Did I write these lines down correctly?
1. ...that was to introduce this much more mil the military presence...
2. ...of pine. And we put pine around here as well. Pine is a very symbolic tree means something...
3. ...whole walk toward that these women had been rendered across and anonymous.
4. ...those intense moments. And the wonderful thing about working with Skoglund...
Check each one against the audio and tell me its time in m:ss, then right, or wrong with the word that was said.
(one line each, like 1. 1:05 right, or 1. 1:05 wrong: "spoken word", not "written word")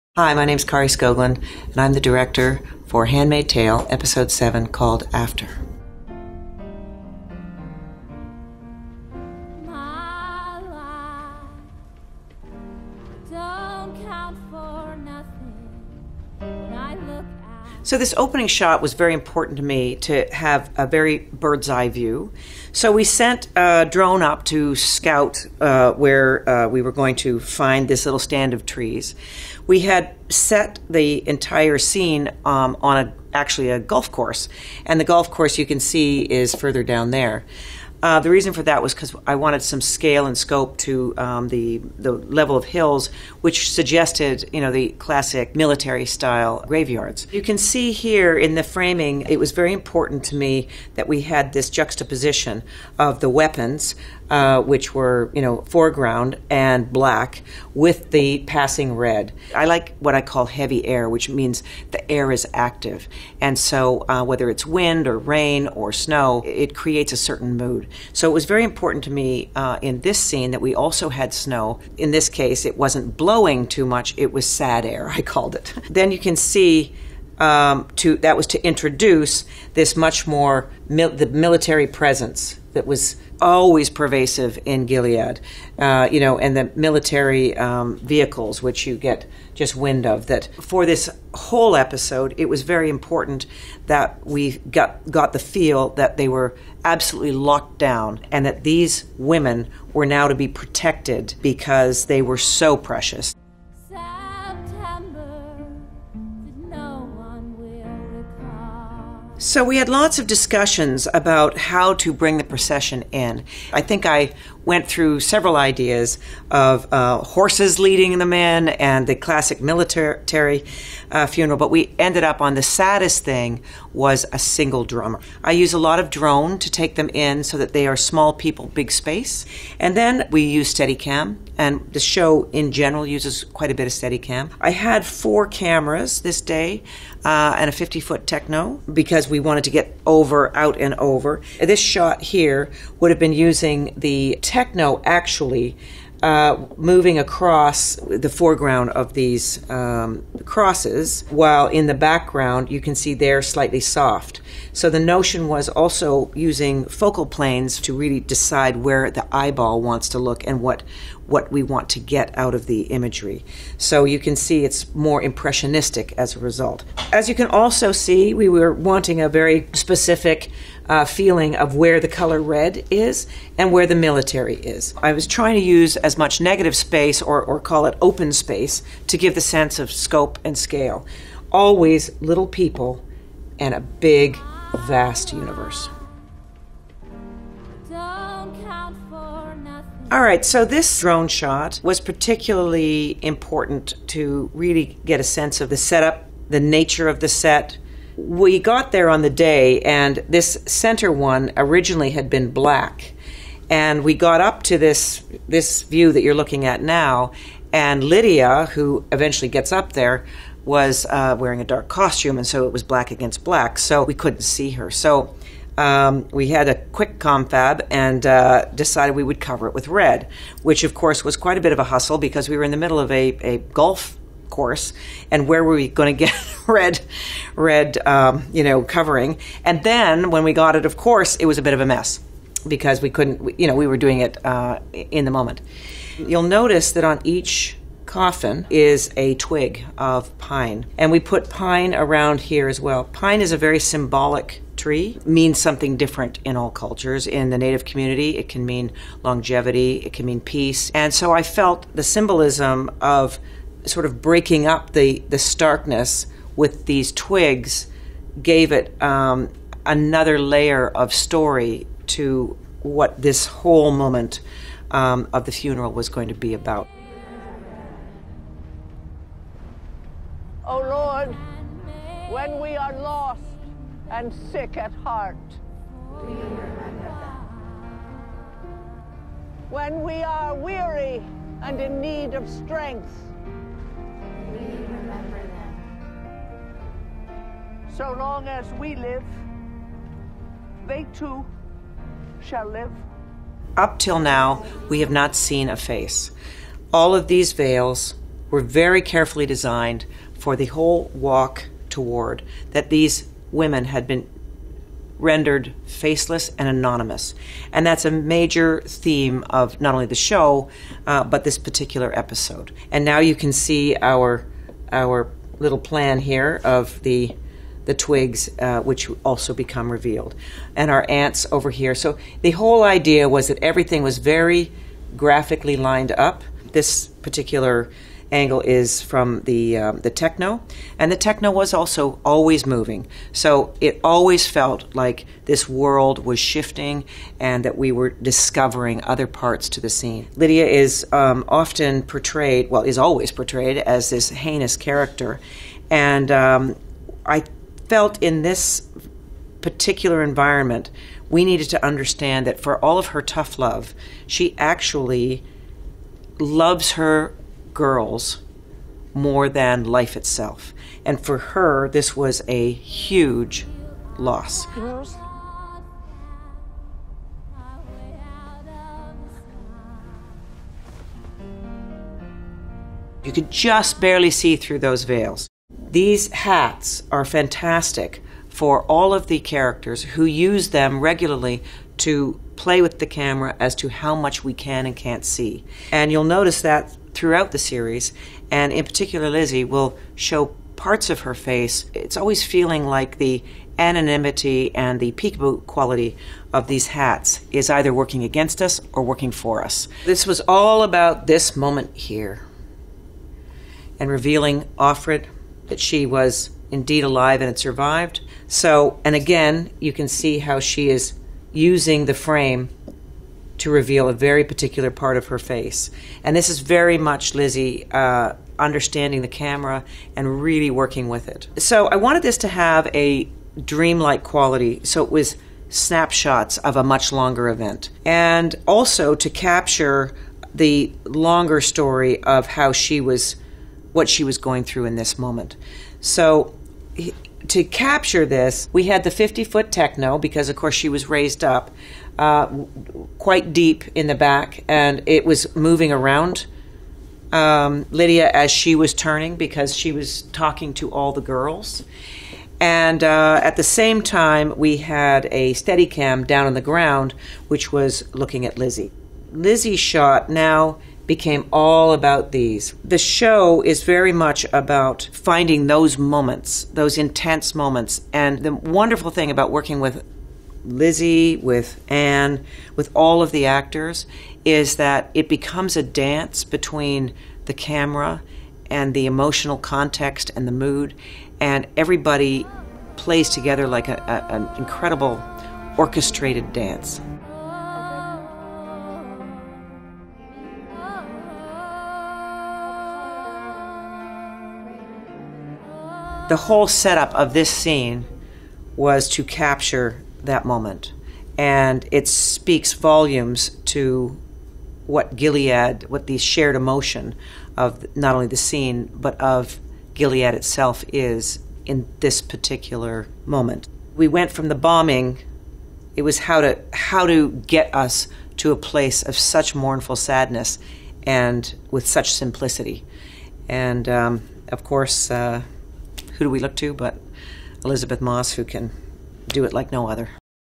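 1. 1:18 right
2. 3:59 right
3. 5:00 wrong: "faceless", not "across"
4. 7:46 wrong: "Lizzie", not "Skoglund".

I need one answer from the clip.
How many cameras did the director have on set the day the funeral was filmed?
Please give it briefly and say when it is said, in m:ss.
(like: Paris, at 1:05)
4, at 2:15.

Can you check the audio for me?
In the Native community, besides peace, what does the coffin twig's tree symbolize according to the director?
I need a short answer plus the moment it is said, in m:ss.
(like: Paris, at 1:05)
Longevity, at 4:09.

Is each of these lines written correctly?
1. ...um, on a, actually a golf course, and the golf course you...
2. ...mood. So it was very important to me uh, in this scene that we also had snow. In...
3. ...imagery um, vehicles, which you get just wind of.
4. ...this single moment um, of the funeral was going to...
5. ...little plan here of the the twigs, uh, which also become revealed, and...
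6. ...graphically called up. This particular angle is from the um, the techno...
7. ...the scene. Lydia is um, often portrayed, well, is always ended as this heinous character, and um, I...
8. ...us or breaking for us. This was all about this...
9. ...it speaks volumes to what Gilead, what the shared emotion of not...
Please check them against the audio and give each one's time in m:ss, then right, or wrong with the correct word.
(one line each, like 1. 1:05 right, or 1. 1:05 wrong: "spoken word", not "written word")
1. 0:32 right
2. 1:07 right
3. 1:26 wrong: "military", not "imagery"
4. 4:23 wrong: "whole", not "single"
5. 5:15 right
6. 5:25 wrong: "lined", not "called"
7. 5:39 wrong: "portrayed", not "ended"
8. 6:38 wrong: "working", not "breaking"
9. 8:21 right.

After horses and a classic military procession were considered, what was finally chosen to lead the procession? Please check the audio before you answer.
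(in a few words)
A single drummer.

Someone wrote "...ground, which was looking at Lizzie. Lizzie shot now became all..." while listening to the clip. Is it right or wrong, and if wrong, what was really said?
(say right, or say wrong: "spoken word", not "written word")
right.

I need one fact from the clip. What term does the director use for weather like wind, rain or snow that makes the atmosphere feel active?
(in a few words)
Heavy air.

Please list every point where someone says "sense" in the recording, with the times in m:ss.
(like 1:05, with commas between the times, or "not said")
2:59, 3:15.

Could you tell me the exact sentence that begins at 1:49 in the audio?
So we had lots of discussions about how to bring the procession in.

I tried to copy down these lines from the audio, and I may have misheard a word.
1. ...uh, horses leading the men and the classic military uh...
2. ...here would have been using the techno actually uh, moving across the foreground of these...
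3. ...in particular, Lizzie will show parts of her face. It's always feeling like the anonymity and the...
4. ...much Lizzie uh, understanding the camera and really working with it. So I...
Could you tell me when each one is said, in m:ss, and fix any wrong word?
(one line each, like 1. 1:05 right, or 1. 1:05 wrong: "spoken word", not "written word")
1. 1:56 right
2. 2:22 right
3. 6:28 right
4. 6:56 right.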